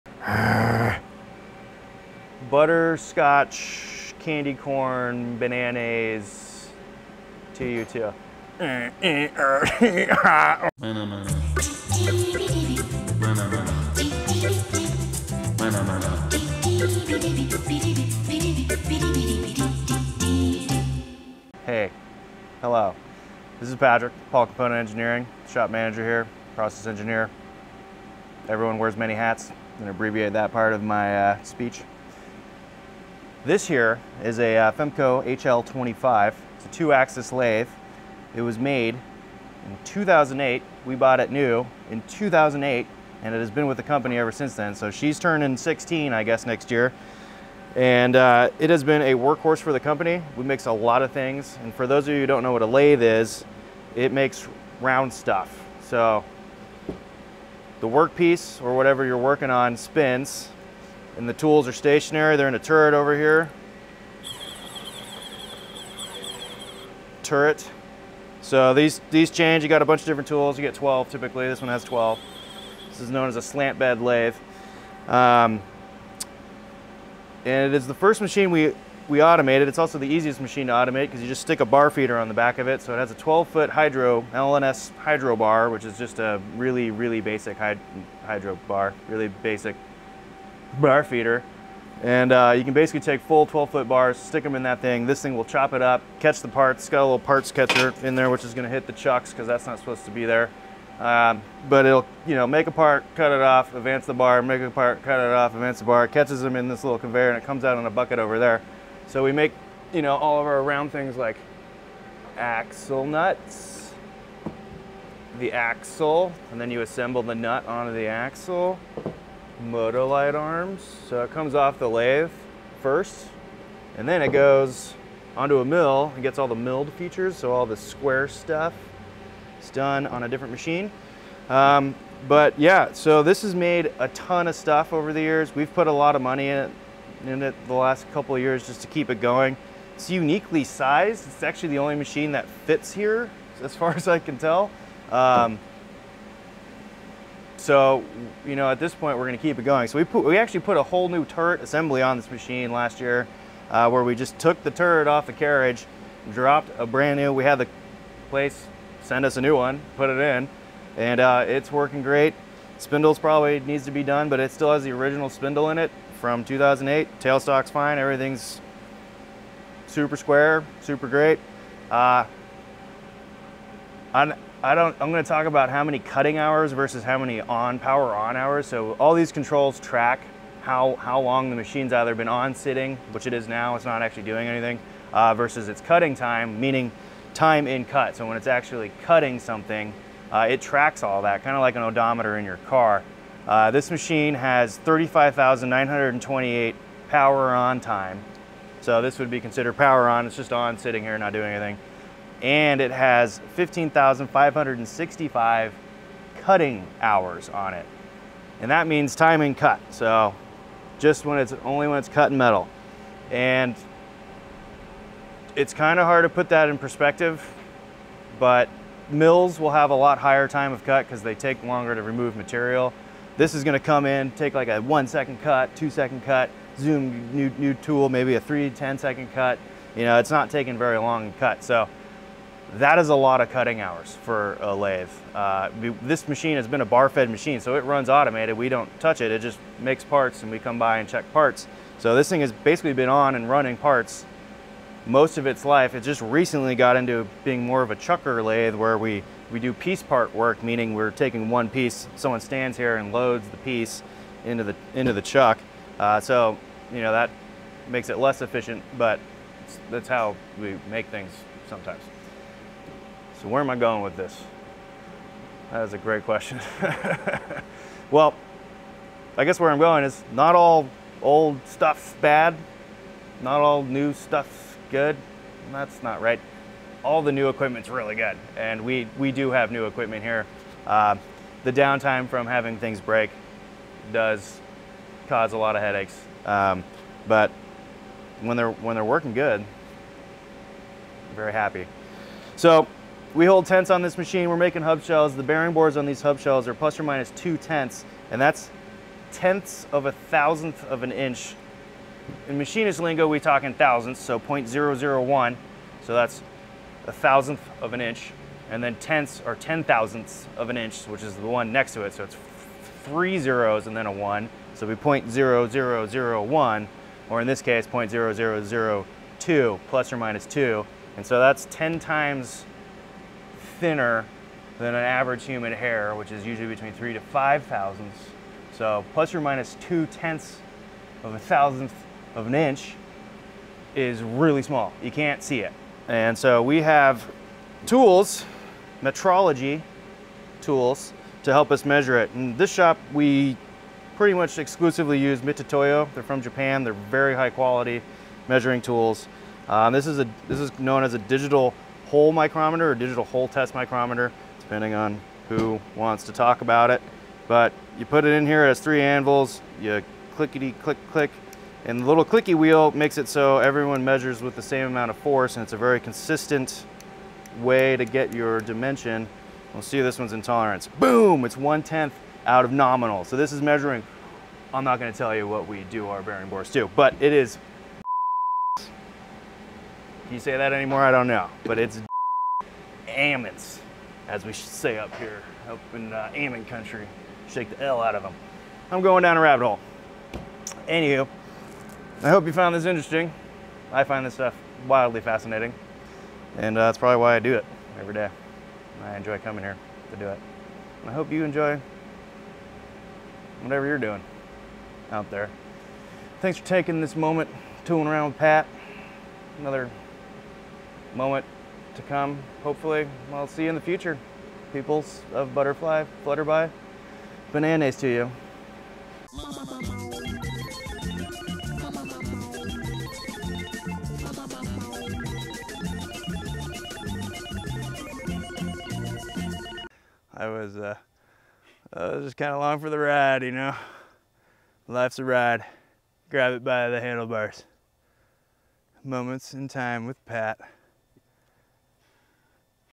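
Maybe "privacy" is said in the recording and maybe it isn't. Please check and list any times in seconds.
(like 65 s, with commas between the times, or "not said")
not said.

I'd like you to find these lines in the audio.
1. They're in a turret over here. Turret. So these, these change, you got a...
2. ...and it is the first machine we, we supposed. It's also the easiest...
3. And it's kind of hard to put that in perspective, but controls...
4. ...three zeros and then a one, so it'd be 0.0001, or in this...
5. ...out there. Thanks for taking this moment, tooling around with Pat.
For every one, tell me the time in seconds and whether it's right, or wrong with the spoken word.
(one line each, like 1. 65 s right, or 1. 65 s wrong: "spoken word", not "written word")
1. 62 s right
2. 77 s wrong: "automated", not "supposed"
3. 213 s wrong: "mills", not "controls"
4. 313 s right
5. 405 s right.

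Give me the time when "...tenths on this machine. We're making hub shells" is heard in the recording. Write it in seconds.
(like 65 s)
293 s.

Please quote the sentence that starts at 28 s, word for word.
Everyone wears many hats, and abbreviate that part of my uh, speech.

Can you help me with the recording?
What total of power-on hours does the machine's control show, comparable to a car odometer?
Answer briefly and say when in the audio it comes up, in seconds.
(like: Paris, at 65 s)
35,928, at 194 s.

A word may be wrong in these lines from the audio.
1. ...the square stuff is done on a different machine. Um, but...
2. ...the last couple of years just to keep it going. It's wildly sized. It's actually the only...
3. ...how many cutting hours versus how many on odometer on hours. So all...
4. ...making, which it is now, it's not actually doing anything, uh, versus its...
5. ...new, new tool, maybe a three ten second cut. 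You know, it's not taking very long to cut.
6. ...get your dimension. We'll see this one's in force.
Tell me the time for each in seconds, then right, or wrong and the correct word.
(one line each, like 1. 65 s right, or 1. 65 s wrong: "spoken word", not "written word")
1. 127 s right
2. 137 s wrong: "uniquely", not "wildly"
3. 175 s wrong: "power", not "odometer"
4. 182 s wrong: "sitting", not "making"
5. 227 s right
6. 368 s wrong: "tolerance", not "force".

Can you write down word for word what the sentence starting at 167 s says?
Tailstock's fine, everything's super square, super great.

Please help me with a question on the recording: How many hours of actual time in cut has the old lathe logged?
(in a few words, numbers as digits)
15,565.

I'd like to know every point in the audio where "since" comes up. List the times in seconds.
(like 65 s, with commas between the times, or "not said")
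44 s.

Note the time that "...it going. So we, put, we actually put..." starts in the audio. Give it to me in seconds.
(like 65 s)
149 s.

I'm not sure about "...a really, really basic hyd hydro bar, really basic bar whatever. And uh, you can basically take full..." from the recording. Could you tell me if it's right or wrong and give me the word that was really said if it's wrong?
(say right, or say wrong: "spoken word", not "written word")
wrong: "feeder", not "whatever".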